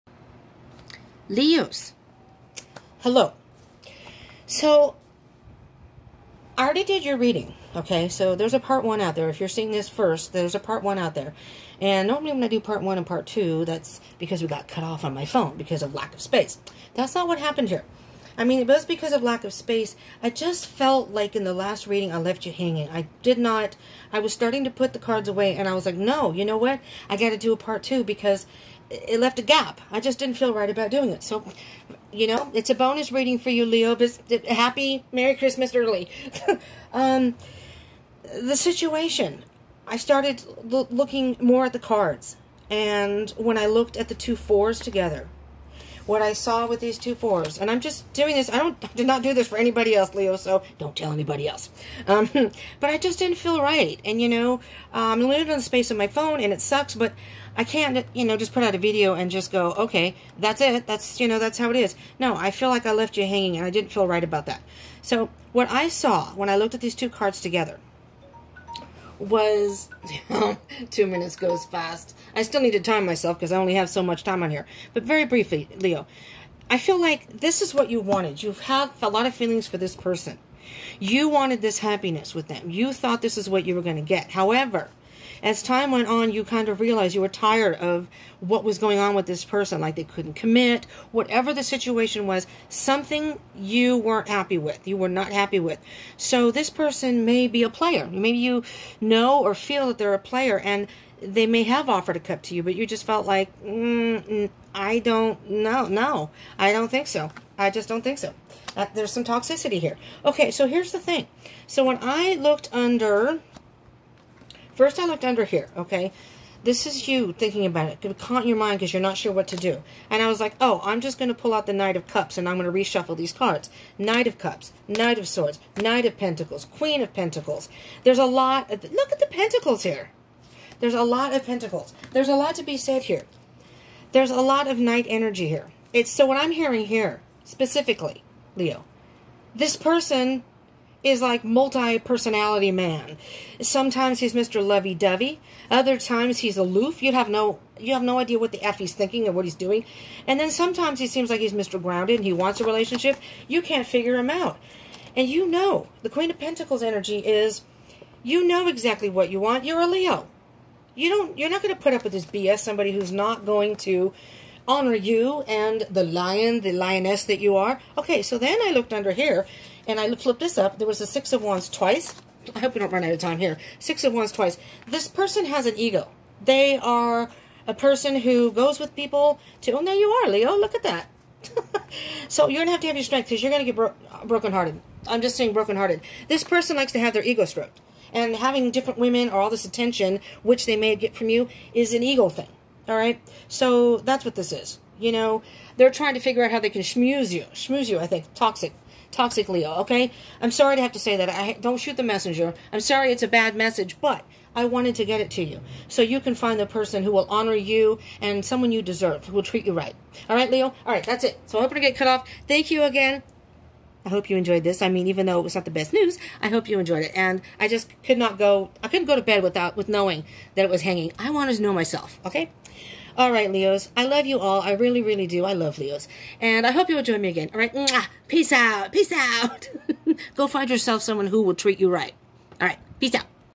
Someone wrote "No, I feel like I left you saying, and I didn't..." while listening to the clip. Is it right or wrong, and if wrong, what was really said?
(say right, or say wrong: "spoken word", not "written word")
wrong: "hanging", not "saying".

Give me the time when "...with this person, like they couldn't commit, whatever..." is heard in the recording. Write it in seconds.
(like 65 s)
89 s.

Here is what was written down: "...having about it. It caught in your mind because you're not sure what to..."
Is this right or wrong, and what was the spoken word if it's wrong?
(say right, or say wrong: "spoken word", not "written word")
wrong: "thinking", not "having".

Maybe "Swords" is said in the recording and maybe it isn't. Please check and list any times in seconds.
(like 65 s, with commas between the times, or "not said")
125 s.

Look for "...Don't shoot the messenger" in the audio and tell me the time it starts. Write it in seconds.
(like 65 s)
201 s.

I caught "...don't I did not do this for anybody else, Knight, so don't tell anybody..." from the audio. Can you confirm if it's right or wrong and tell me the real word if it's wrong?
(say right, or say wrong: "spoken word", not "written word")
wrong: "Leo", not "Knight".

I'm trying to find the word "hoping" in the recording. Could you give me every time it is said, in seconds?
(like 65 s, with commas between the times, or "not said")
211 s.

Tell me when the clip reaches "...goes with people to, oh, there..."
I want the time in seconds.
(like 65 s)
178 s.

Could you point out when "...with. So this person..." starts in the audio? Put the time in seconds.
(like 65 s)
95 s.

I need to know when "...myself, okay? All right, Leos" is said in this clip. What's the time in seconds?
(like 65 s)
221 s.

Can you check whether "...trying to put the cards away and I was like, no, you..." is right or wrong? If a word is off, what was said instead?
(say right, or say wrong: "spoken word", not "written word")
wrong: "starting", not "trying".